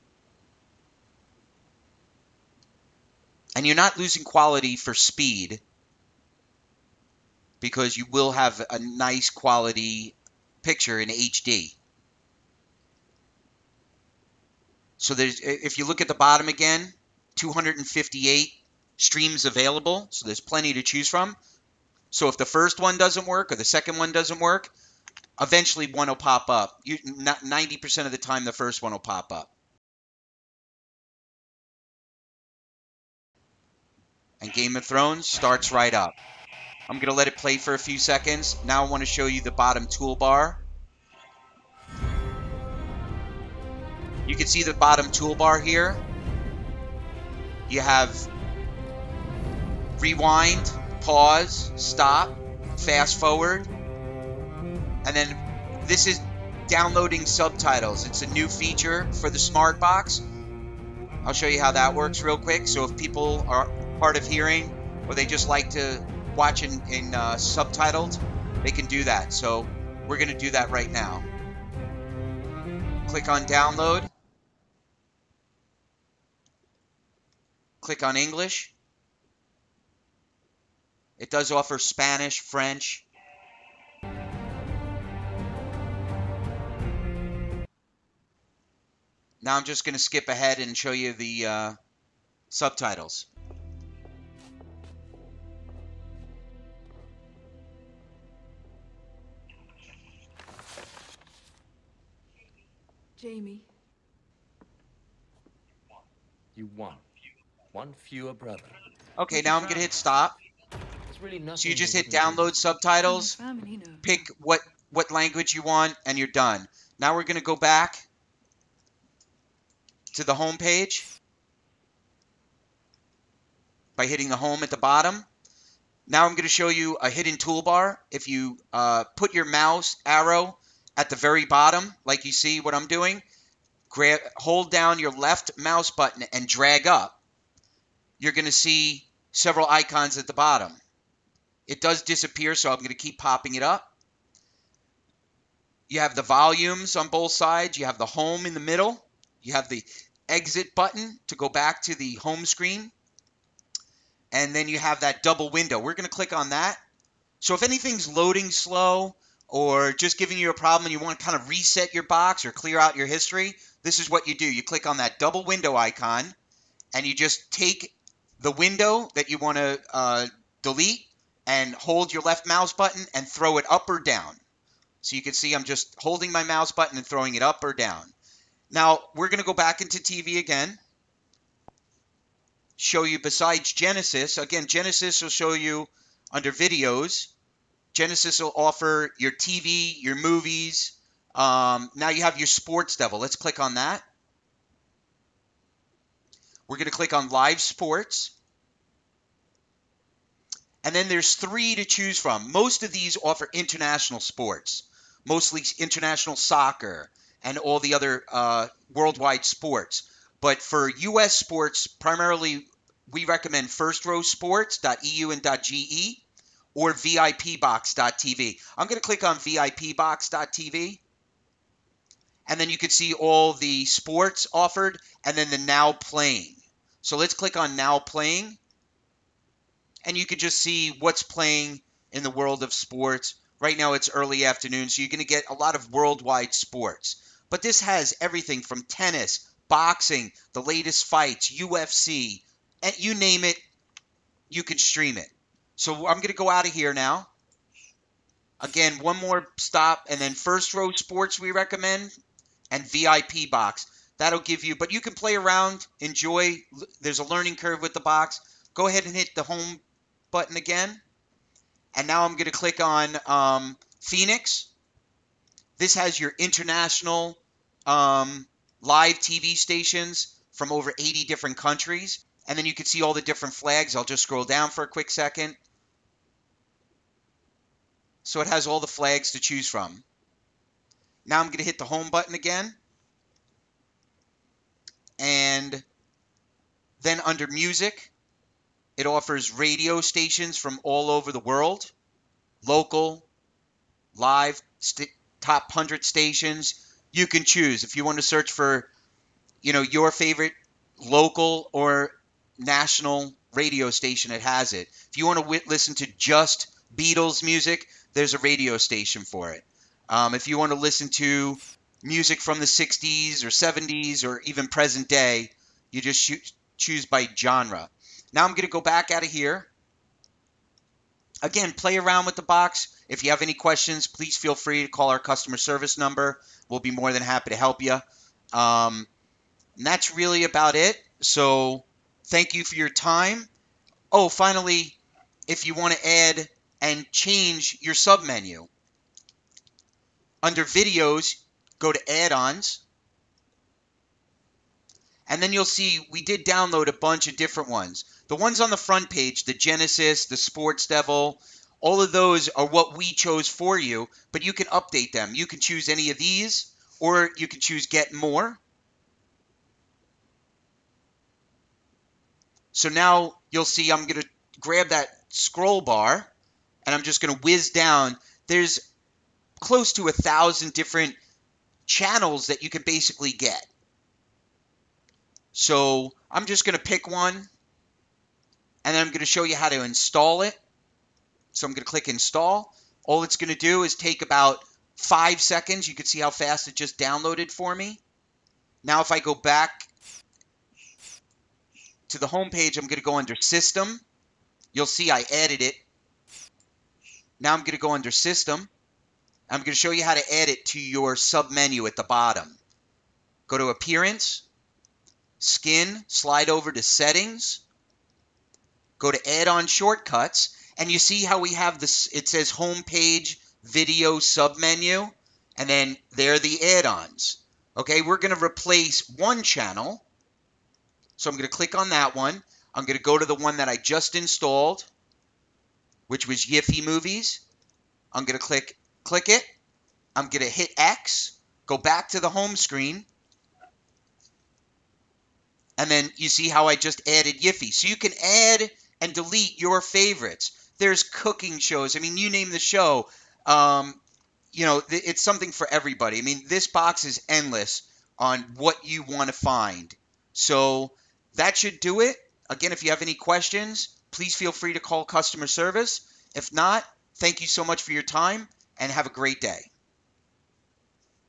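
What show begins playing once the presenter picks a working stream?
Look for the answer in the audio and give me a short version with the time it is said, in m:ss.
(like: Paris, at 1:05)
Game of Thrones, at 0:34.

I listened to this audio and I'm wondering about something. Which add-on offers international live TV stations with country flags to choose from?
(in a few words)
Phoenix.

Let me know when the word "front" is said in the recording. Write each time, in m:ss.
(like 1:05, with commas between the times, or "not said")
5:48.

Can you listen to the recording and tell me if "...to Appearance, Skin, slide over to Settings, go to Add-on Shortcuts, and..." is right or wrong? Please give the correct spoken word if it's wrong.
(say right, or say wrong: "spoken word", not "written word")
right.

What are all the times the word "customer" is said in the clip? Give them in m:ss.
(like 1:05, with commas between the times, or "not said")
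5:25, 7:35.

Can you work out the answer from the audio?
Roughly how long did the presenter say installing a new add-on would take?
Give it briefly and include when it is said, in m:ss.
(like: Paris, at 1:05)
5 seconds, at 6:24.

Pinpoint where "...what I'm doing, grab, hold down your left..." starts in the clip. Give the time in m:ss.
2:12.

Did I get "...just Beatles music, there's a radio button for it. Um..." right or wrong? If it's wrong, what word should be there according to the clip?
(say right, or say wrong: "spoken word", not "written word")
wrong: "station", not "button".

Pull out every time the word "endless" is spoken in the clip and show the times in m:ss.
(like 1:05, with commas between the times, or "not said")
7:27.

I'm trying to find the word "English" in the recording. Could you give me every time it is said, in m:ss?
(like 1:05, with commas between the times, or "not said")
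1:18.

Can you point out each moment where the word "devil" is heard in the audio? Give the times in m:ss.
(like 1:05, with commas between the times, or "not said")
3:12, 5:50.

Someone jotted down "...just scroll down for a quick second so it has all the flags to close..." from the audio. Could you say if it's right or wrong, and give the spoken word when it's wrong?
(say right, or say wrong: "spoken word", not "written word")
wrong: "choose", not "close".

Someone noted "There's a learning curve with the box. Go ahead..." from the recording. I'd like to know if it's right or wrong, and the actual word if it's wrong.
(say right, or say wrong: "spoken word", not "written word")
right.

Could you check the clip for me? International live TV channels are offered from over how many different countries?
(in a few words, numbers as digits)
80.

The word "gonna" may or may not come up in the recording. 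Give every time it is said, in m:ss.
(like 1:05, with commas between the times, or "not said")
1:49, 1:57.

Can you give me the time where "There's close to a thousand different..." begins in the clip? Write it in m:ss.
6:08.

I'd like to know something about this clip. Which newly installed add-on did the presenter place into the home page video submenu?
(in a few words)
YIFY Movies.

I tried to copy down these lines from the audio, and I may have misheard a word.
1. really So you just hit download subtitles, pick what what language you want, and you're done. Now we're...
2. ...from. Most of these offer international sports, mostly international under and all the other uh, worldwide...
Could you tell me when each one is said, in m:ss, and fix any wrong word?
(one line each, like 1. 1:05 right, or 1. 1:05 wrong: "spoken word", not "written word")
1. 1:51 right
2. 3:22 wrong: "soccer", not "under".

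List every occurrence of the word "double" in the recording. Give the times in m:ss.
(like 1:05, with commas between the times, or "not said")
2:35, 2:45.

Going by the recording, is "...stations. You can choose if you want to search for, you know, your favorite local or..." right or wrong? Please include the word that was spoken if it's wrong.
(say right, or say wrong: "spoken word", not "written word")
right.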